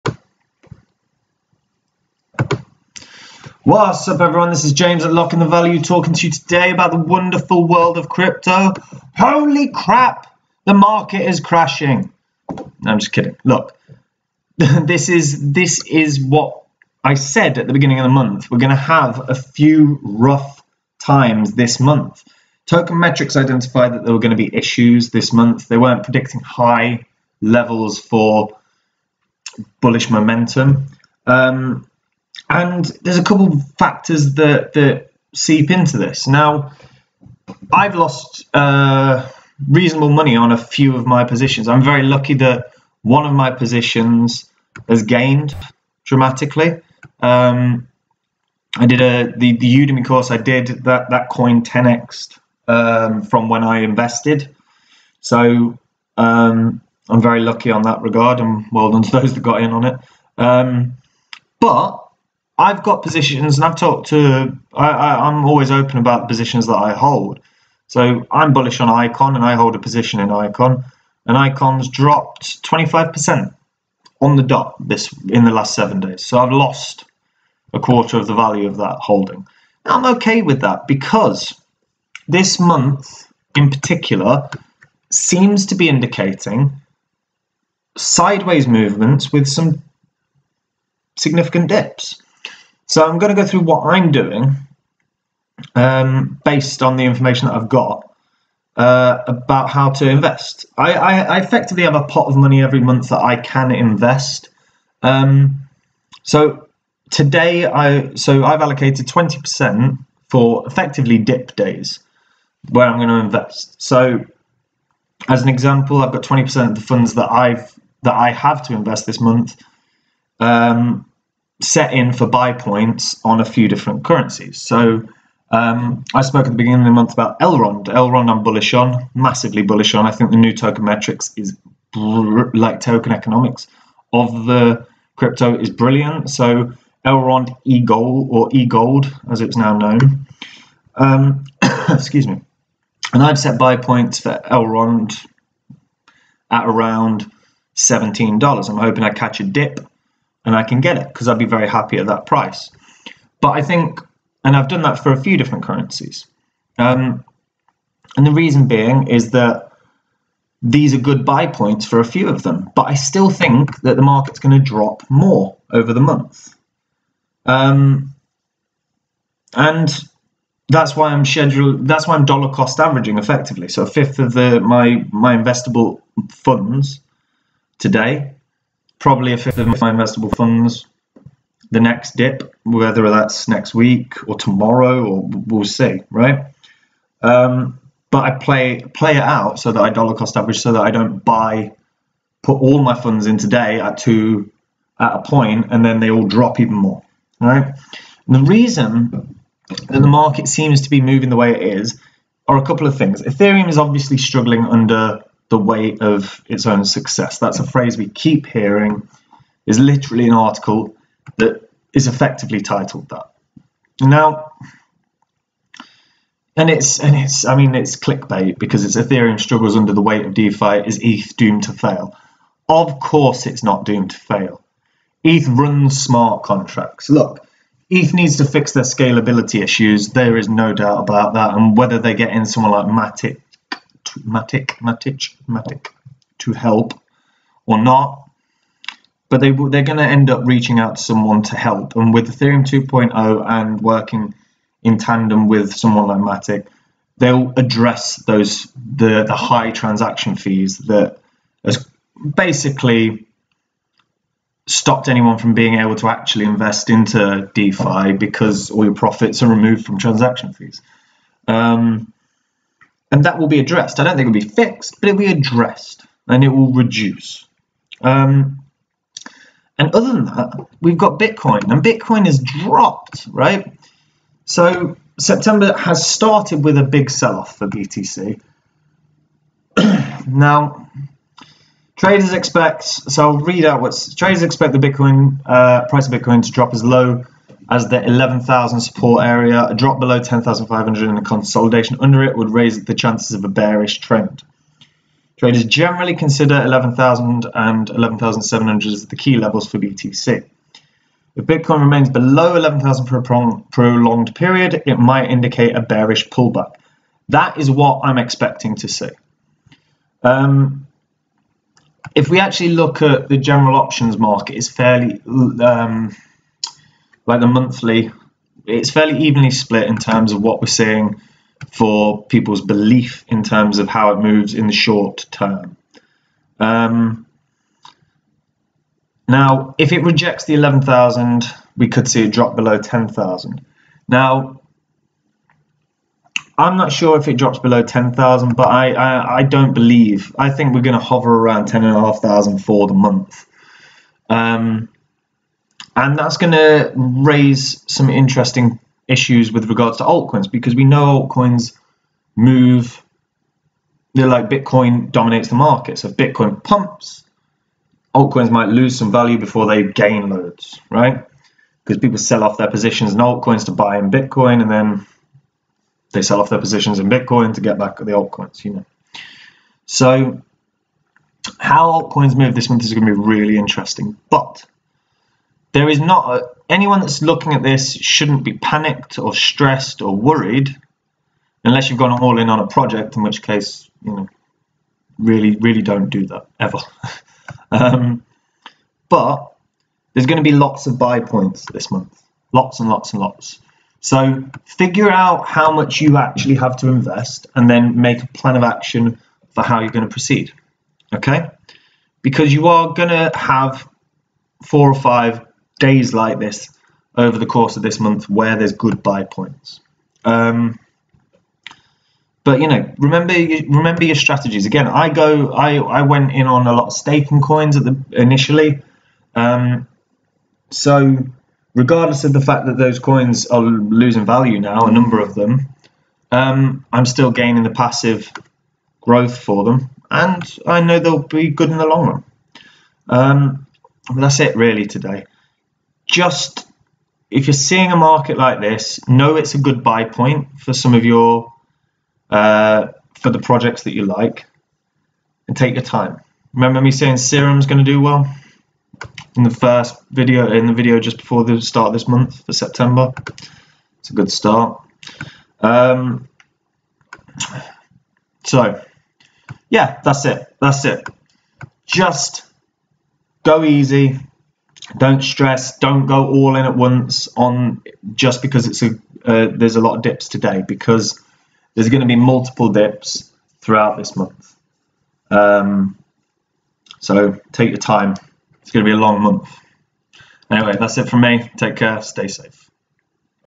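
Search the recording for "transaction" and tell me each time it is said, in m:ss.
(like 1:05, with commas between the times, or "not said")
4:09, 4:19.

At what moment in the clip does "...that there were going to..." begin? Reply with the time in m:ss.
0:23.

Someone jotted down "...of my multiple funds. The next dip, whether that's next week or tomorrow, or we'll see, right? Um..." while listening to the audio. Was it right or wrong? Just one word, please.
wrong.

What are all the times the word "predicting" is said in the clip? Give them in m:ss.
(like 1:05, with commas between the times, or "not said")
0:26.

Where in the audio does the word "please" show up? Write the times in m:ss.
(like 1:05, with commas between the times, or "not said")
not said.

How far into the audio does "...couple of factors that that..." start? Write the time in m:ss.
0:33.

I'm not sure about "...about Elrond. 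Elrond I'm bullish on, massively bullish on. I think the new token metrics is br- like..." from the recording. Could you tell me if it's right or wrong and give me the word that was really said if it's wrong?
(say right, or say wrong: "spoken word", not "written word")
right.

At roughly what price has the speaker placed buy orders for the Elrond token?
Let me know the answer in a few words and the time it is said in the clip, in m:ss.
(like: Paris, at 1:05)
$17, at 2:27.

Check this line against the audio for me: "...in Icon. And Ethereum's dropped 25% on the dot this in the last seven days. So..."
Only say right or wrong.
wrong.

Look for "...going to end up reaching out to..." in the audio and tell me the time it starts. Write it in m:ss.
3:59.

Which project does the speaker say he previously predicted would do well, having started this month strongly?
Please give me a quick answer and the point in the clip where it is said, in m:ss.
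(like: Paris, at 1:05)
Serum, at 7:27.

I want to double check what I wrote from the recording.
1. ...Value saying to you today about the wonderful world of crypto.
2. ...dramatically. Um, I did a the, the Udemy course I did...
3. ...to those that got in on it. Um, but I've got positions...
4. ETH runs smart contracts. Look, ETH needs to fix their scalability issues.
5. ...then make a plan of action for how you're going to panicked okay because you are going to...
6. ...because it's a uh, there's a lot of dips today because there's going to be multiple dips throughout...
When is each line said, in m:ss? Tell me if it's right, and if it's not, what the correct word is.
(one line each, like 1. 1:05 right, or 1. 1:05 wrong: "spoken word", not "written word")
1. 0:05 wrong: "talking", not "saying"
2. 0:46 right
3. 0:59 right
4. 3:45 right
5. 6:37 wrong: "proceed", not "panicked"
6. 7:48 right.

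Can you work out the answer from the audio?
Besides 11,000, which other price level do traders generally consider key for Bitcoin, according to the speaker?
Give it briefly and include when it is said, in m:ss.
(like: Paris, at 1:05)
11,700, at 4:57.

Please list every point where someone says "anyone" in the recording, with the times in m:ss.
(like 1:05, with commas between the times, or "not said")
4:15, 6:16.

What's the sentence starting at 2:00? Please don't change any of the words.
Um, set in for buy points on a few different currencies.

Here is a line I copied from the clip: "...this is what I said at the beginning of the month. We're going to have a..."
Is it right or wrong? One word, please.
right.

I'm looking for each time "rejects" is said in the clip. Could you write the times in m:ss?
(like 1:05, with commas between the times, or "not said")
5:30.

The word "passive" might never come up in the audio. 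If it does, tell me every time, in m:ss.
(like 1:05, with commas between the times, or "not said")
7:07.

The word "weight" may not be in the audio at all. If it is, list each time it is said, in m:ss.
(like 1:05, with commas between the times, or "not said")
3:25, 3:40.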